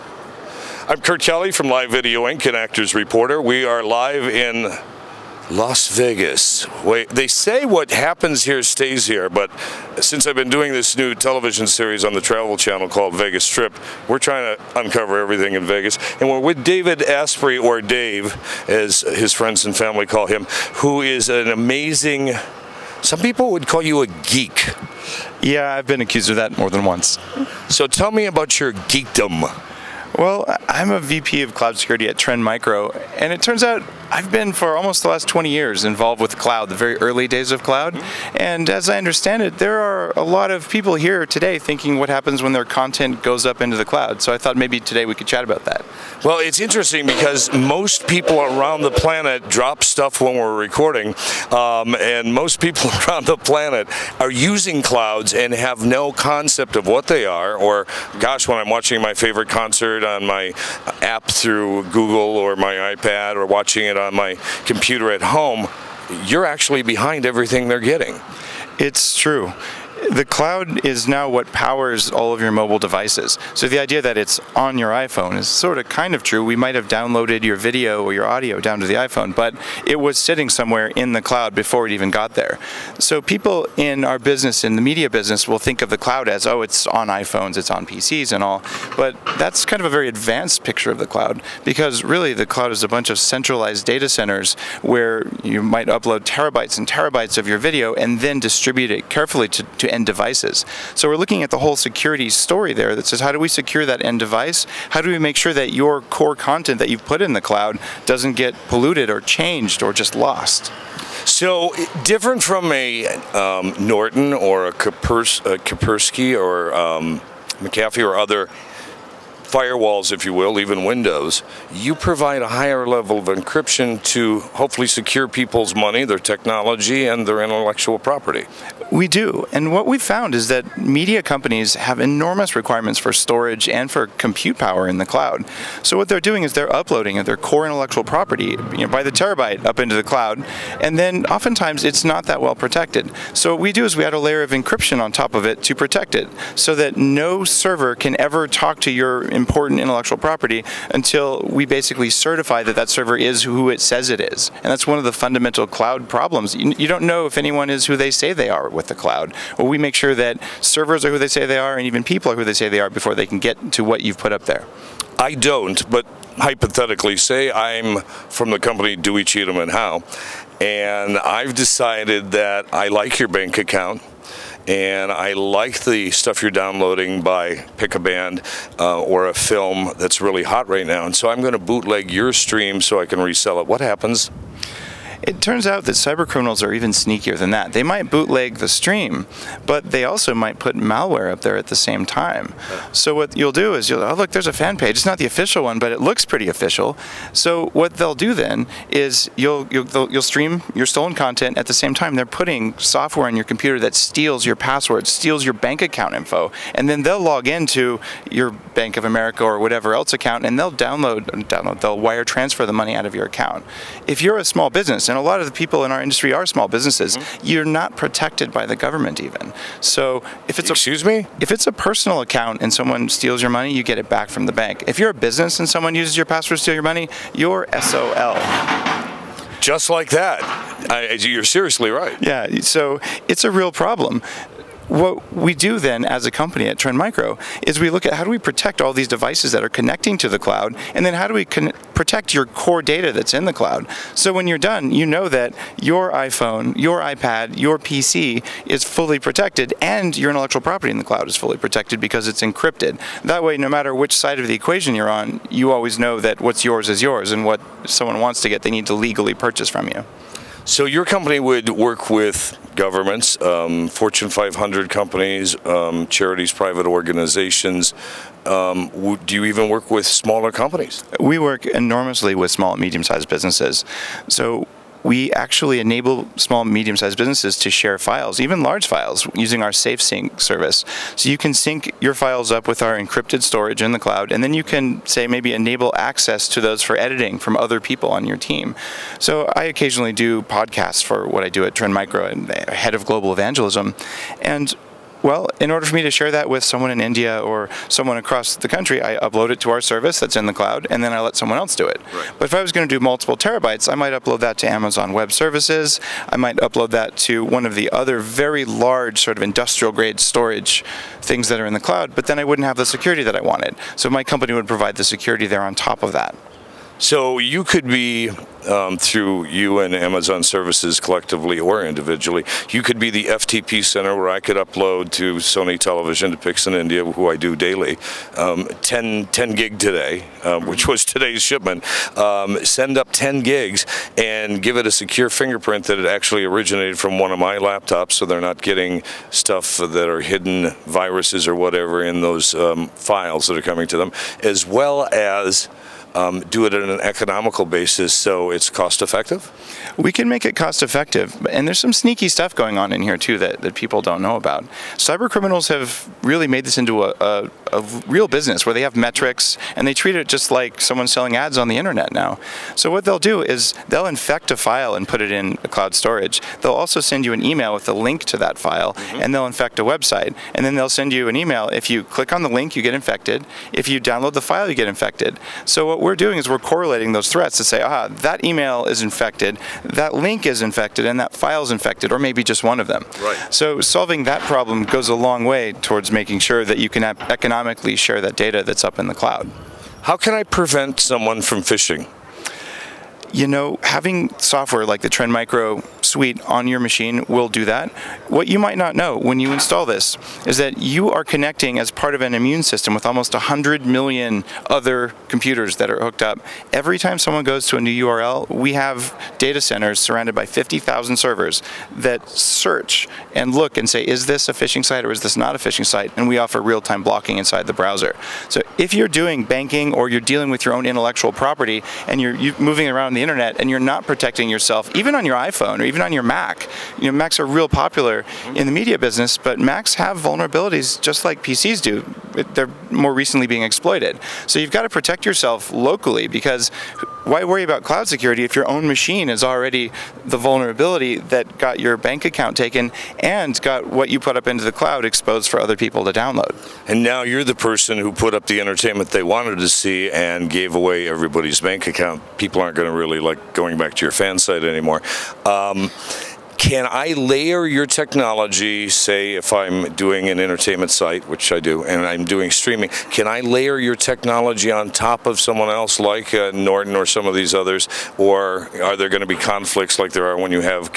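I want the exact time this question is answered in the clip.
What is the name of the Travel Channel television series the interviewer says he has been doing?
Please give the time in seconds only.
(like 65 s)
13 s.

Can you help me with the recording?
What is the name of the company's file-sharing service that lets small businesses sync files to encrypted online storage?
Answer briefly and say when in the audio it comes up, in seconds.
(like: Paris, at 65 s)
SafeSync, at 279 s.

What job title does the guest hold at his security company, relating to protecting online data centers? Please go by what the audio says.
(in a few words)
VP of cloud security.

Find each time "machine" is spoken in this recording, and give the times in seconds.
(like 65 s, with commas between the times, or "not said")
396 s, 438 s.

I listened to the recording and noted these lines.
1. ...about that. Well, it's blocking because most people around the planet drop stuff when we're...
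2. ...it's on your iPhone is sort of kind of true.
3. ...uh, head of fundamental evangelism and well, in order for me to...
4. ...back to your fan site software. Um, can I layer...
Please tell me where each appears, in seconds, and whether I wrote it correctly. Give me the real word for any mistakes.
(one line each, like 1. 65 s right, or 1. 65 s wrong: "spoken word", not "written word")
1. 45 s wrong: "interesting", not "blocking"
2. 74 s right
3. 292 s wrong: "global", not "fundamental"
4. 453 s wrong: "anymore", not "software".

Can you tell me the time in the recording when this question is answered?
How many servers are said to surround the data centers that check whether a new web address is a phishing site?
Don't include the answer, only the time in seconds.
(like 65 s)
410 s.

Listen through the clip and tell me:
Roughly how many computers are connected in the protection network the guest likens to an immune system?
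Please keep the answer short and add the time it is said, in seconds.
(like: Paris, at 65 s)
almost 100 million, at 403 s.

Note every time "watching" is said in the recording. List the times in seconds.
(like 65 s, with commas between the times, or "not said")
58 s, 63 s.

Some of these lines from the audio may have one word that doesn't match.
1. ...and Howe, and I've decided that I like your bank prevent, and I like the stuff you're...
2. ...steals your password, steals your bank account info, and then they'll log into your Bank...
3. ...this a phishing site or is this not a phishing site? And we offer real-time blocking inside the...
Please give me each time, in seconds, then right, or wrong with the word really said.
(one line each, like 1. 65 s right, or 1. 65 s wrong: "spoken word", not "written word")
1. 169 s wrong: "account", not "prevent"
2. 203 s right
3. 414 s right.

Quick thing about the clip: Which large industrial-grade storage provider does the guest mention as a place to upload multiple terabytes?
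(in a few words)
Amazon Web Services.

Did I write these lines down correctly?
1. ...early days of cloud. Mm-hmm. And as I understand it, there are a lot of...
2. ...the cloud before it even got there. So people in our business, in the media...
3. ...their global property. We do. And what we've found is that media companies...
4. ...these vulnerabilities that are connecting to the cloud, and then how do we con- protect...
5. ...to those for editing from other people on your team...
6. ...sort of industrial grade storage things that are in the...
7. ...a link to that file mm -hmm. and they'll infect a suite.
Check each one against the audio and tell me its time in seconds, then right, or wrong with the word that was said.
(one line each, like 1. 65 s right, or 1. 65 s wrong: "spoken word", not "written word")
1. 36 s right
2. 81 s right
3. 127 s wrong: "intellectual", not "global"
4. 238 s wrong: "devices", not "vulnerabilities"
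5. 286 s right
6. 309 s right
7. 367 s wrong: "website", not "suite".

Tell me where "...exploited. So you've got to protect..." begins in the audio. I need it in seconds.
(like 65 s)
433 s.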